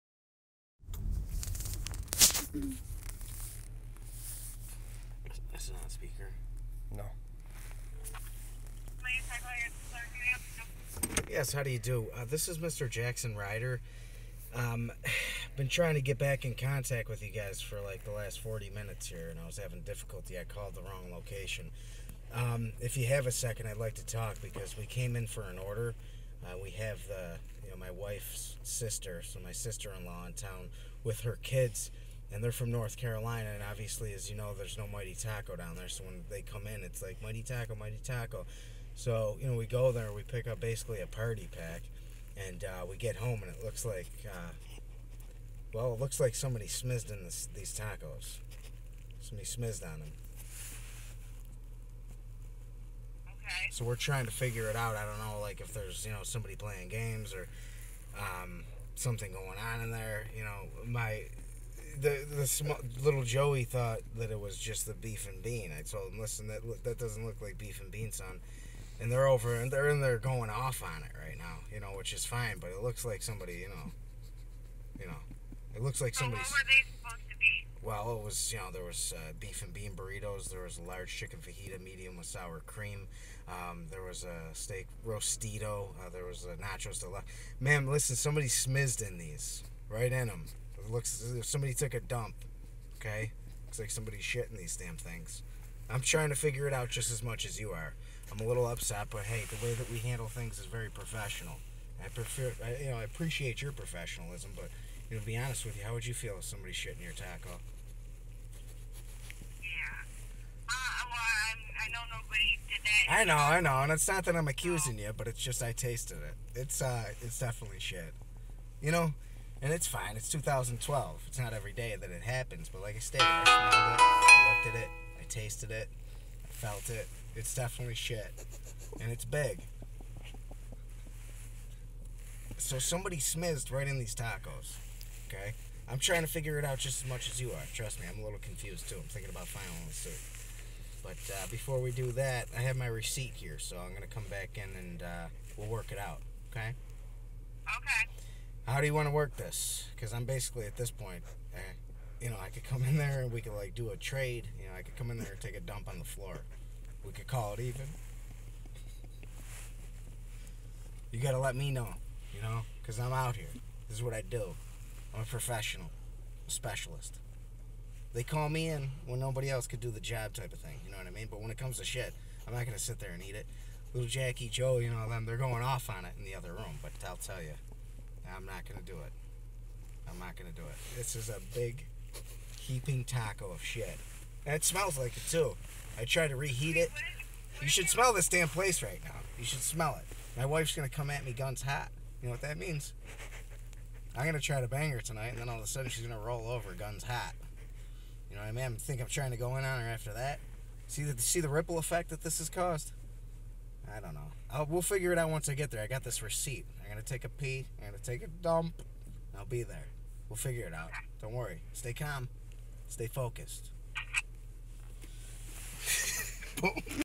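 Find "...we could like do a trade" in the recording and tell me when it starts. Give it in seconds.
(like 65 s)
153 s.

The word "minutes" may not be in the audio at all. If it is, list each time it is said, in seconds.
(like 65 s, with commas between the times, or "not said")
18 s.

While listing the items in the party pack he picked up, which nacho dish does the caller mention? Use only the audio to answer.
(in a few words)
Nachos deluxe.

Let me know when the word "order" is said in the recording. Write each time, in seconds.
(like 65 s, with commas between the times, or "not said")
25 s.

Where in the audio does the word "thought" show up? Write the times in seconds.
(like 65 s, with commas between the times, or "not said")
63 s.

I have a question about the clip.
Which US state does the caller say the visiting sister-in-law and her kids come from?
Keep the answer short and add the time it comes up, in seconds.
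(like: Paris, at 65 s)
North Carolina, at 32 s.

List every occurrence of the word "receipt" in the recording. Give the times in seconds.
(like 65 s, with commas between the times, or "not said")
142 s, 206 s.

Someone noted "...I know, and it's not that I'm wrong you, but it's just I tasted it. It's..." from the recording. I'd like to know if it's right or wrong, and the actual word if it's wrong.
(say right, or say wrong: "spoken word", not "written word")
wrong: "accusing", not "wrong".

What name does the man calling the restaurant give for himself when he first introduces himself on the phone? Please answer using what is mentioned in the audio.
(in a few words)
Jackson Ryder.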